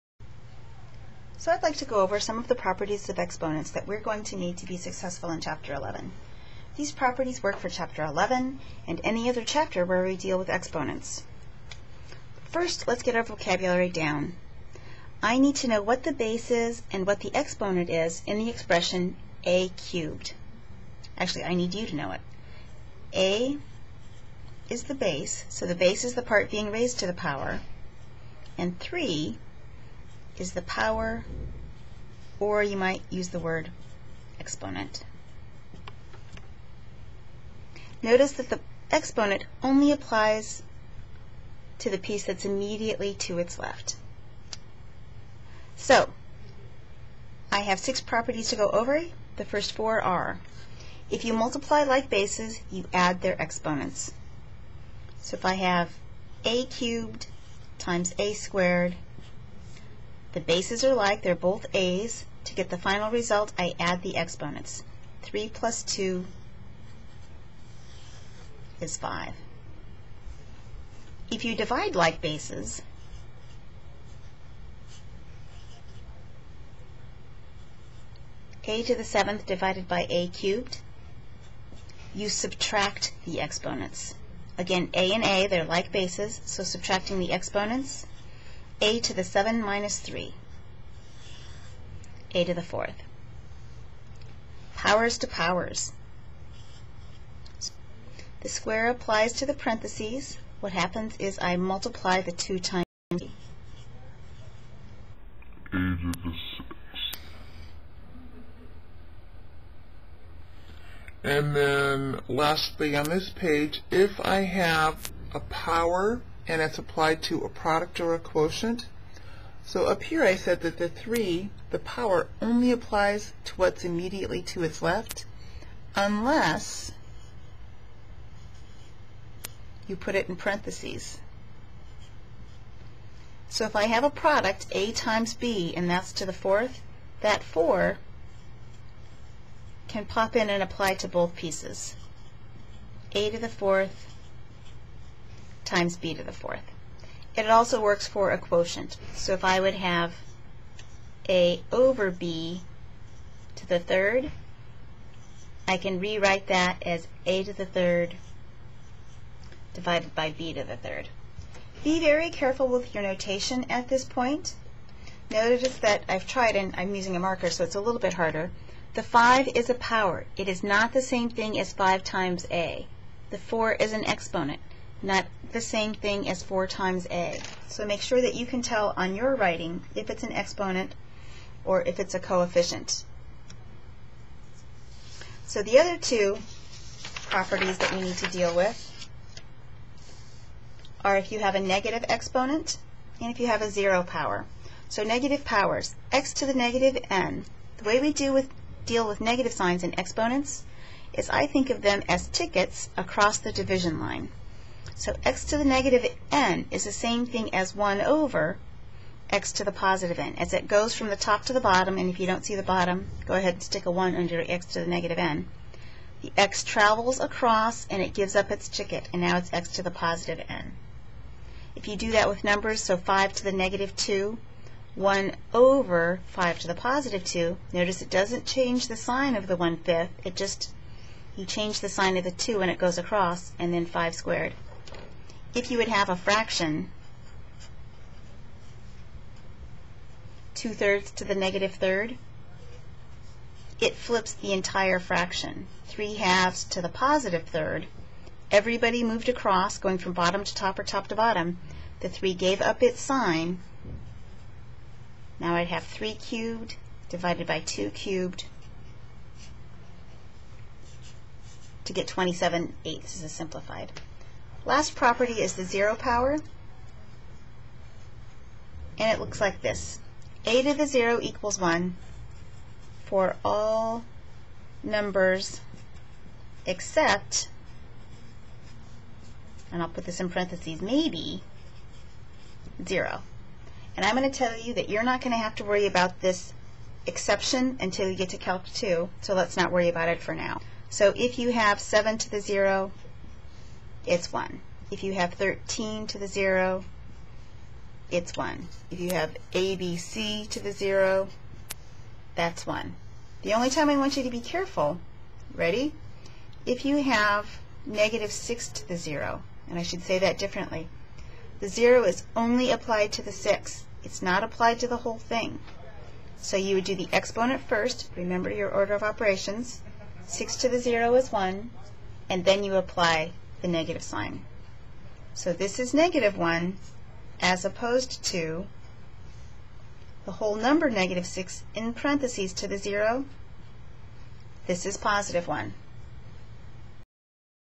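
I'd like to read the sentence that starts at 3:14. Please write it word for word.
So negative powers, x to the negative n.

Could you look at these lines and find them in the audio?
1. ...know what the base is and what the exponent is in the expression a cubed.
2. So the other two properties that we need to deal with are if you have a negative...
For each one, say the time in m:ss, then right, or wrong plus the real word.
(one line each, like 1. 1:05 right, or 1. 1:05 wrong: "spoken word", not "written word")
1. 0:15 right
2. 3:05 right.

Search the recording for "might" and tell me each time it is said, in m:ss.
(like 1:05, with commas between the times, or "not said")
0:32.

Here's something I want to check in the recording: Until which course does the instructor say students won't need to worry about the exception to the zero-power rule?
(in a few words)
Calc 2.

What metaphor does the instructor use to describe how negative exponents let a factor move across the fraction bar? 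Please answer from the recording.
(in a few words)
tickets.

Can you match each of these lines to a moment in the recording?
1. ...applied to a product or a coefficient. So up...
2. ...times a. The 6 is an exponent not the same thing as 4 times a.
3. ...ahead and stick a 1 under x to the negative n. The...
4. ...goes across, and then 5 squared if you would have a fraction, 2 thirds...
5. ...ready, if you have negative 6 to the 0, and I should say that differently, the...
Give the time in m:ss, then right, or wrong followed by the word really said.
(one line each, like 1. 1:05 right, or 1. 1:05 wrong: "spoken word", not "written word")
1. 1:56 wrong: "quotient", not "coefficient"
2. 2:52 wrong: "4", not "6"
3. 3:33 right
4. 3:52 right
5. 5:05 right.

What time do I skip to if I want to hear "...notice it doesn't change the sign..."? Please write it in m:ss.
3:47.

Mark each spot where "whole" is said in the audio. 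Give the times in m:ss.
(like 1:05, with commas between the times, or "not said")
5:14, 5:30.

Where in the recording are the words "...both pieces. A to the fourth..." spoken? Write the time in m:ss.
2:21.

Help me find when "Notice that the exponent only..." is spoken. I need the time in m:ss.
0:38.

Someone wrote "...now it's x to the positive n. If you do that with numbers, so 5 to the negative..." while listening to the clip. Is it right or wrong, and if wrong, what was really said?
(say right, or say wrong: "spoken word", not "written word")
right.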